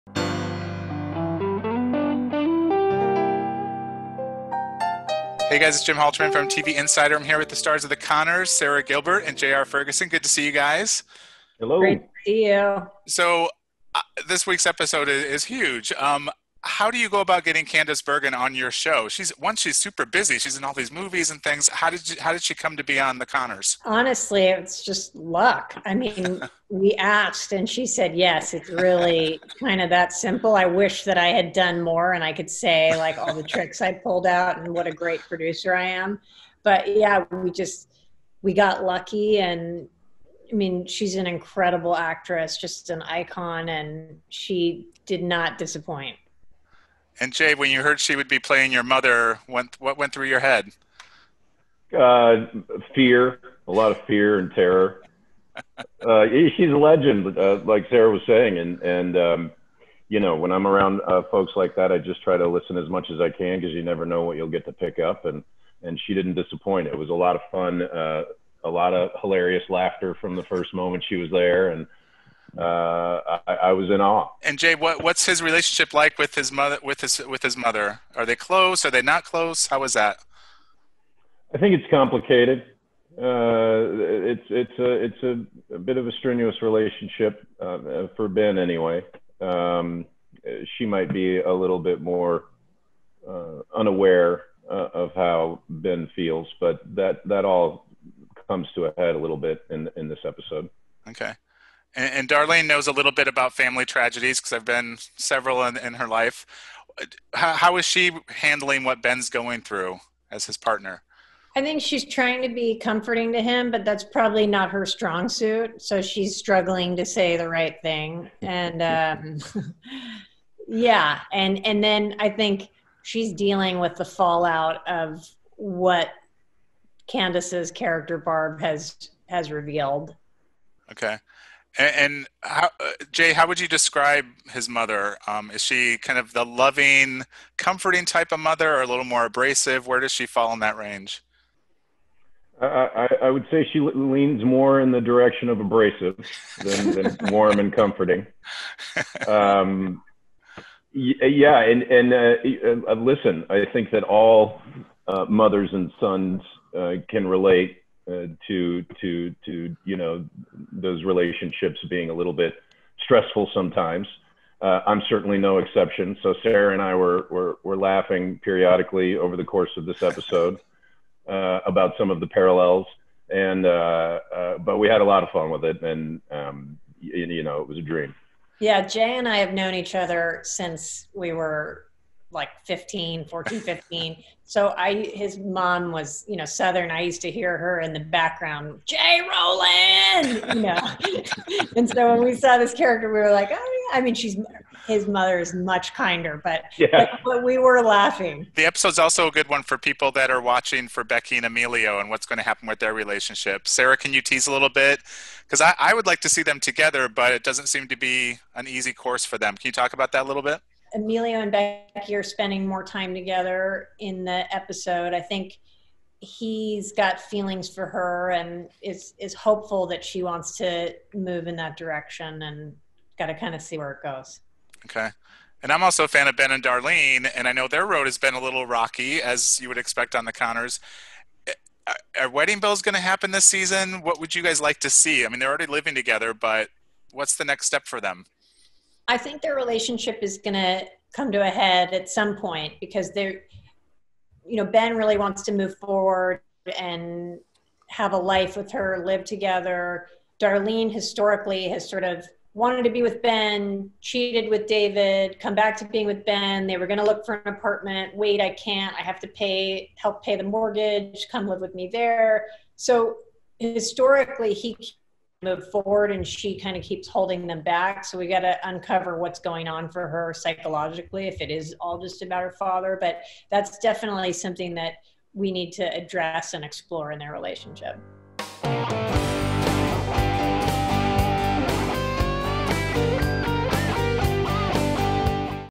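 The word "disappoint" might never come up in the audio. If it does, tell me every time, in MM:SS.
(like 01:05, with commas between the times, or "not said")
00:45, 01:06.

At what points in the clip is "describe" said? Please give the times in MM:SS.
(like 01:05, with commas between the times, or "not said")
02:13.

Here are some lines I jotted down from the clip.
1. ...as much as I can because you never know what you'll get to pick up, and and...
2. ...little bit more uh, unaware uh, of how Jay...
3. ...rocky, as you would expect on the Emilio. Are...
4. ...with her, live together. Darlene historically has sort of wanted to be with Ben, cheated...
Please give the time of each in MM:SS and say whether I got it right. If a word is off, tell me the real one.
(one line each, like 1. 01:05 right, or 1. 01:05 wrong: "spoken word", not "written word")
1. 01:02 right
2. 01:31 wrong: "Ben", not "Jay"
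3. 03:48 wrong: "Conners", not "Emilio"
4. 04:08 right.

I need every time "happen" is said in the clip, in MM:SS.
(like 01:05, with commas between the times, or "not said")
03:22, 03:53.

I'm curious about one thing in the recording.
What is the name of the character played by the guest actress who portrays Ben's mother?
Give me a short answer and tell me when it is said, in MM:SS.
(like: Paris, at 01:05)
Barb, at 02:08.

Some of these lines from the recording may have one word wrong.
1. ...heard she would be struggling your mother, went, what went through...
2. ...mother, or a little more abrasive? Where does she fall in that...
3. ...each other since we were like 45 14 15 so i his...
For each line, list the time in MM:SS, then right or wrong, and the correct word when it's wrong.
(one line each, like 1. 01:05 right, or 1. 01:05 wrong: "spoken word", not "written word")
1. 00:47 wrong: "playing", not "struggling"
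2. 02:18 right
3. 02:59 wrong: "15", not "45".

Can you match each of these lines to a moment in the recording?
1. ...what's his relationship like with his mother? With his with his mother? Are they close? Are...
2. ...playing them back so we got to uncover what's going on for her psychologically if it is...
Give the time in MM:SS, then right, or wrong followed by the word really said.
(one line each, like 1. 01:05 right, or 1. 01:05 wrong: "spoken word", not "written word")
1. 01:15 right
2. 04:27 wrong: "holding", not "playing".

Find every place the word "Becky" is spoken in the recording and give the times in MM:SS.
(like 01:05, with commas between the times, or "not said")
03:21, 03:31.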